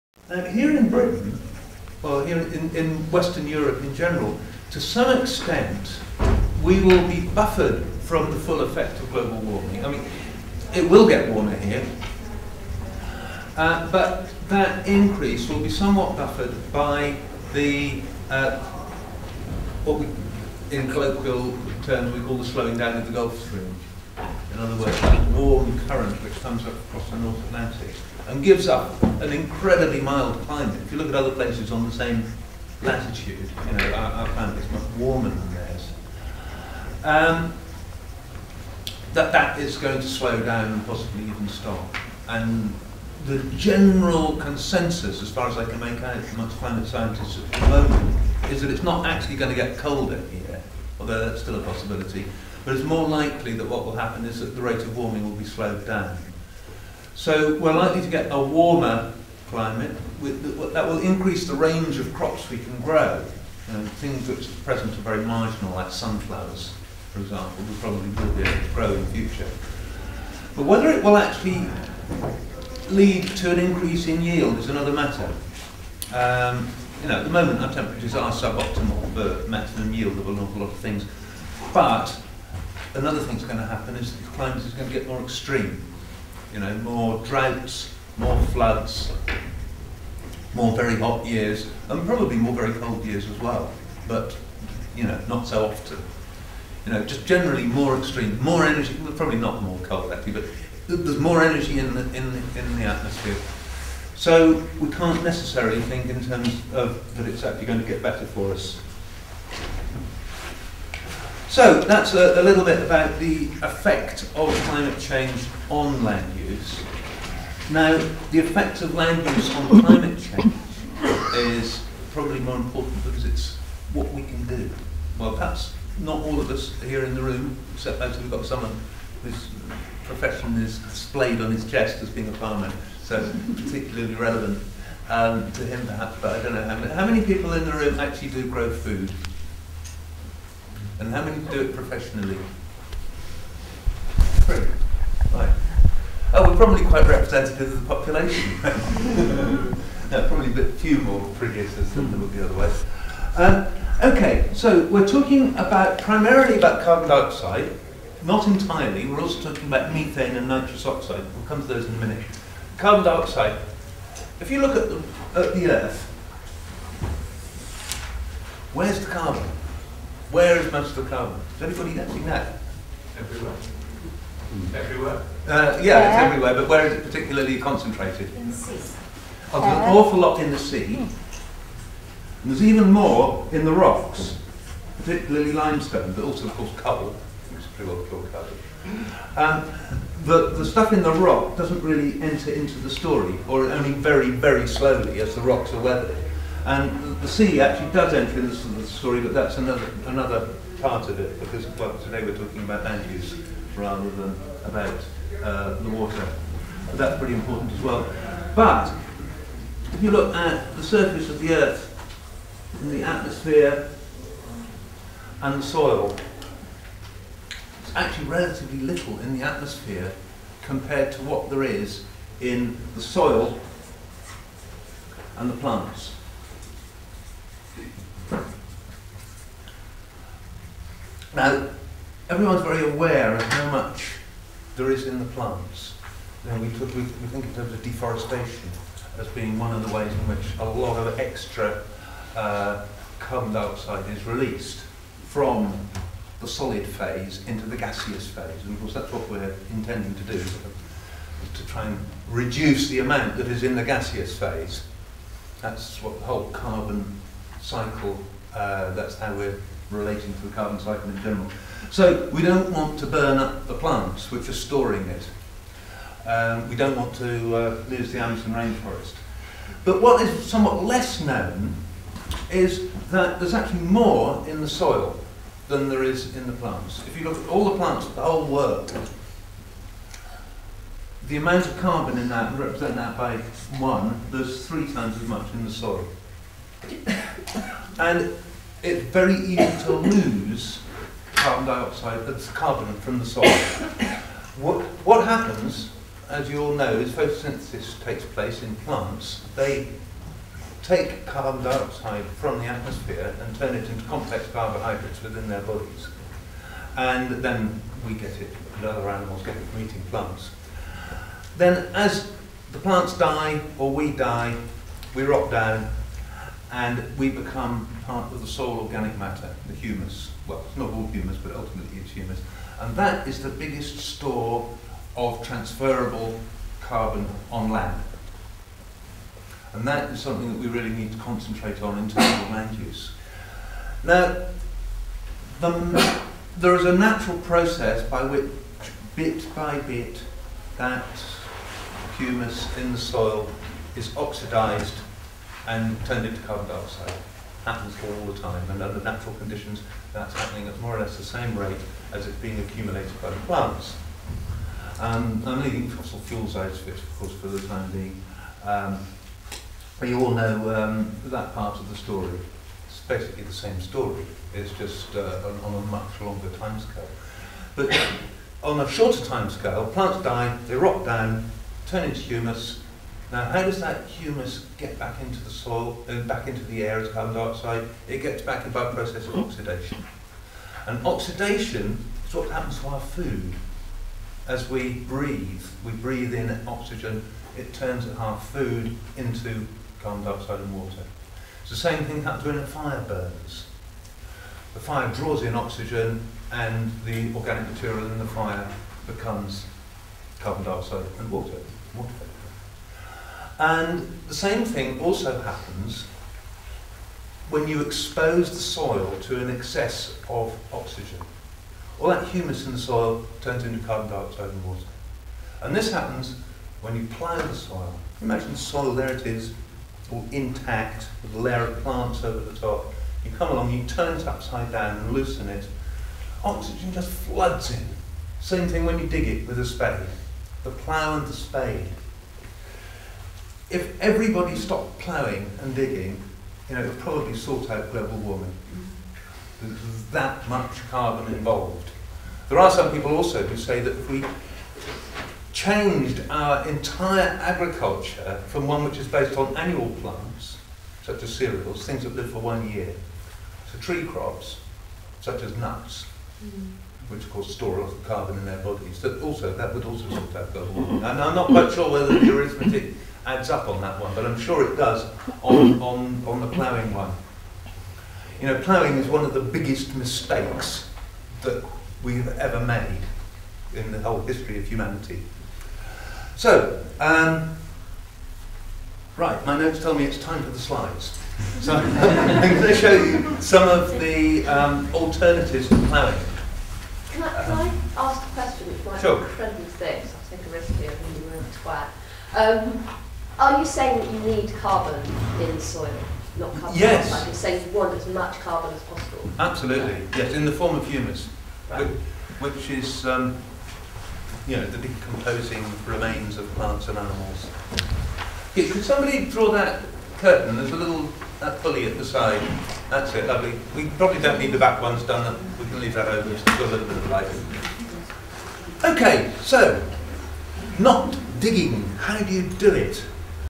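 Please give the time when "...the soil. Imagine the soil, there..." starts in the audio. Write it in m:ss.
6:57.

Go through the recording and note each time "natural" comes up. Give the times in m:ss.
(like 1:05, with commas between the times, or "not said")
5:36, 5:49.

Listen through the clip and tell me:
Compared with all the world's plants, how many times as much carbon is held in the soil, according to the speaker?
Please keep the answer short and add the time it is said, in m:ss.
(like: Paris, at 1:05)
3 times, at 4:44.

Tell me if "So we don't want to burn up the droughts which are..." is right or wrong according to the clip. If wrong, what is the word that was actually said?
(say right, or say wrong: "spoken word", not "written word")
wrong: "plants", not "droughts".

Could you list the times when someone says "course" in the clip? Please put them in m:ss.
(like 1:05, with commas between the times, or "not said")
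3:06, 4:08, 5:57, 7:37.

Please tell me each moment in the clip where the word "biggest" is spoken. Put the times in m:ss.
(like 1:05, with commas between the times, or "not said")
5:23, 7:49.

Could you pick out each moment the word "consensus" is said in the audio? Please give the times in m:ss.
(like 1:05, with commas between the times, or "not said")
0:44.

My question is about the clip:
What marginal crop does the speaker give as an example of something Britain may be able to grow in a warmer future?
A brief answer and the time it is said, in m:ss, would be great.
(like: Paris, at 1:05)
sunflowers, at 1:05.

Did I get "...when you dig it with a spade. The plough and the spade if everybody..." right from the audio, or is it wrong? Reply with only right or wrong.
right.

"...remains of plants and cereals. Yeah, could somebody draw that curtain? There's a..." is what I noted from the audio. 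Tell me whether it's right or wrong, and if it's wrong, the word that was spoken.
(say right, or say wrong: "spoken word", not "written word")
wrong: "animals", not "cereals".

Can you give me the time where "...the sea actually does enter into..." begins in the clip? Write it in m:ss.
3:17.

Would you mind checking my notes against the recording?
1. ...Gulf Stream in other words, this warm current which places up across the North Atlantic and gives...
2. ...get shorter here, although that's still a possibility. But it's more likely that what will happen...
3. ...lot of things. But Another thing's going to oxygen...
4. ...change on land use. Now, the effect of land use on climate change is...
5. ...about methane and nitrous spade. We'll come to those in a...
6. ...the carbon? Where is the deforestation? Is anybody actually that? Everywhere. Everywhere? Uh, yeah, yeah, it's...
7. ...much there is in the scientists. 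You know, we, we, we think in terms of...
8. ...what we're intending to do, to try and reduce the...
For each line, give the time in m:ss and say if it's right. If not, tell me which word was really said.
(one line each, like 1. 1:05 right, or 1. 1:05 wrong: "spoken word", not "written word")
1. 0:23 wrong: "comes", not "places"
2. 0:49 wrong: "colder", not "shorter"
3. 1:20 wrong: "happen", not "oxygen"
4. 1:54 right
5. 2:39 wrong: "oxide", not "spade"
6. 2:48 wrong: "carbon", not "deforestation"
7. 3:53 wrong: "plants", not "scientists"
8. 4:09 right.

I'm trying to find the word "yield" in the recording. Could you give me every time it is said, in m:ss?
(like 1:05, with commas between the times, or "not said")
1:14, 1:19.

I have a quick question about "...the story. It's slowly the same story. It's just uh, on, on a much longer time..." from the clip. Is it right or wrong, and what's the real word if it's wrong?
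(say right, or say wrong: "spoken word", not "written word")
wrong: "basically", not "slowly".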